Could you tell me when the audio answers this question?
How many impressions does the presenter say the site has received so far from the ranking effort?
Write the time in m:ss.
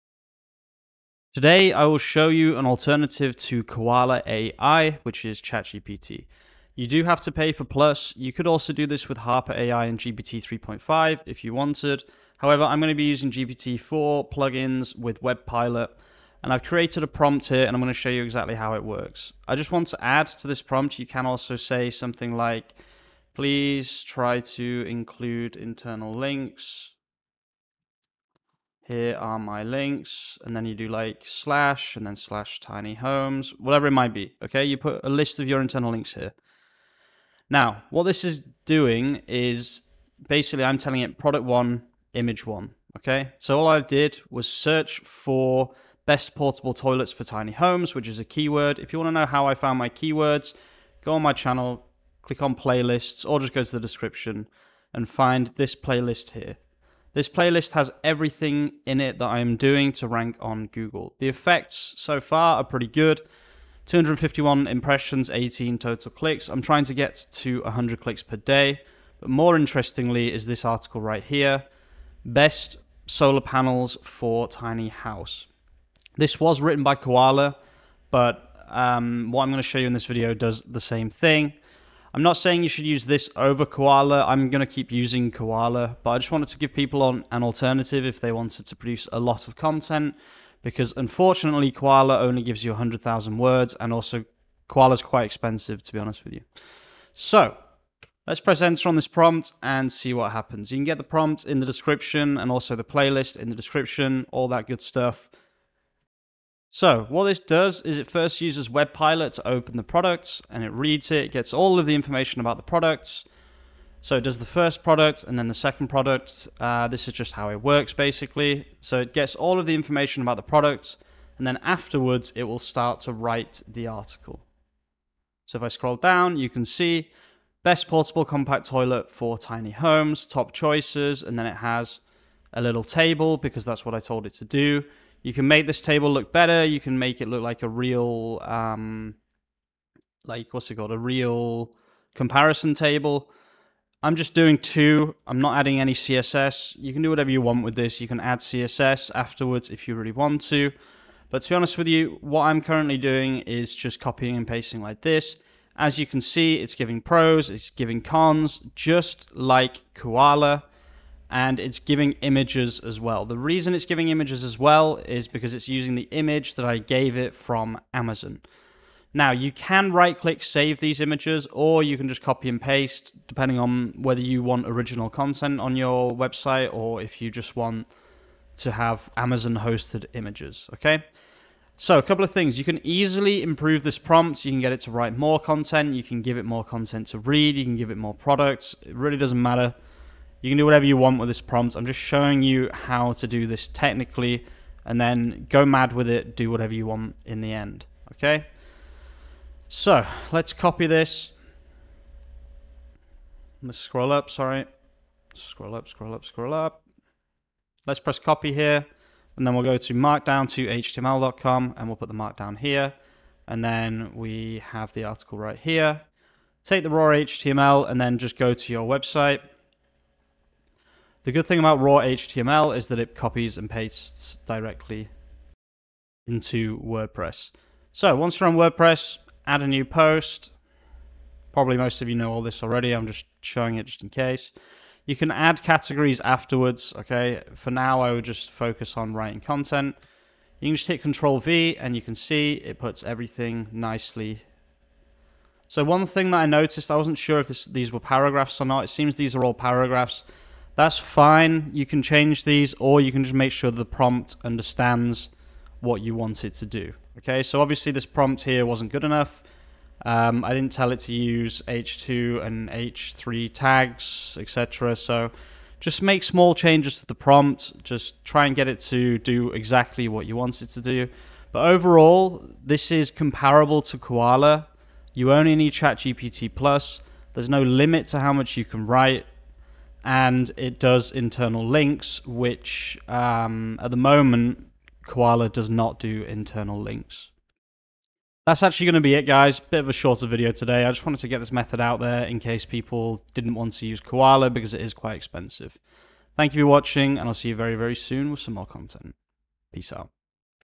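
1:03.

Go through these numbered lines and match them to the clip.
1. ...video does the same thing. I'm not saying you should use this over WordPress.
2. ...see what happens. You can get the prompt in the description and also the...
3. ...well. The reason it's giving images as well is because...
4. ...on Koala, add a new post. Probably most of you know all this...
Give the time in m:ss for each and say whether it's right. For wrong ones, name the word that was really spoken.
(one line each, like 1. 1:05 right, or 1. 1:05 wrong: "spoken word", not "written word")
1. 1:20 wrong: "Koala", not "WordPress"
2. 1:39 right
3. 2:42 right
4. 3:48 wrong: "WordPress", not "Koala".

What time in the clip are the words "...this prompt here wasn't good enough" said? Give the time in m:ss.
4:17.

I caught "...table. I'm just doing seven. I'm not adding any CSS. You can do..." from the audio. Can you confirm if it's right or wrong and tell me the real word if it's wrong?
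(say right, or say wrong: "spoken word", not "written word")
wrong: "two", not "seven".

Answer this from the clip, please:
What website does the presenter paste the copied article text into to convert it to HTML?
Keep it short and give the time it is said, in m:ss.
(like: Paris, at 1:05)
markdown to html.com, at 3:29.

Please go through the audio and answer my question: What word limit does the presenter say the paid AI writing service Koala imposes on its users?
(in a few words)
100,000 words.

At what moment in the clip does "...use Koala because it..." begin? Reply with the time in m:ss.
4:53.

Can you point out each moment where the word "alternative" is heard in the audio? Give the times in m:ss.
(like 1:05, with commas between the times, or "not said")
0:02, 1:27.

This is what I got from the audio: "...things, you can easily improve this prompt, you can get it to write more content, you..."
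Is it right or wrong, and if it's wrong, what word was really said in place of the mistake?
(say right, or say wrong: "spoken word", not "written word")
right.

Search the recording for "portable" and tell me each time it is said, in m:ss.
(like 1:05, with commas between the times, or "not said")
0:46, 2:07.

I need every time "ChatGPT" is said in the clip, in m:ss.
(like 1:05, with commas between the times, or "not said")
0:05, 4:35.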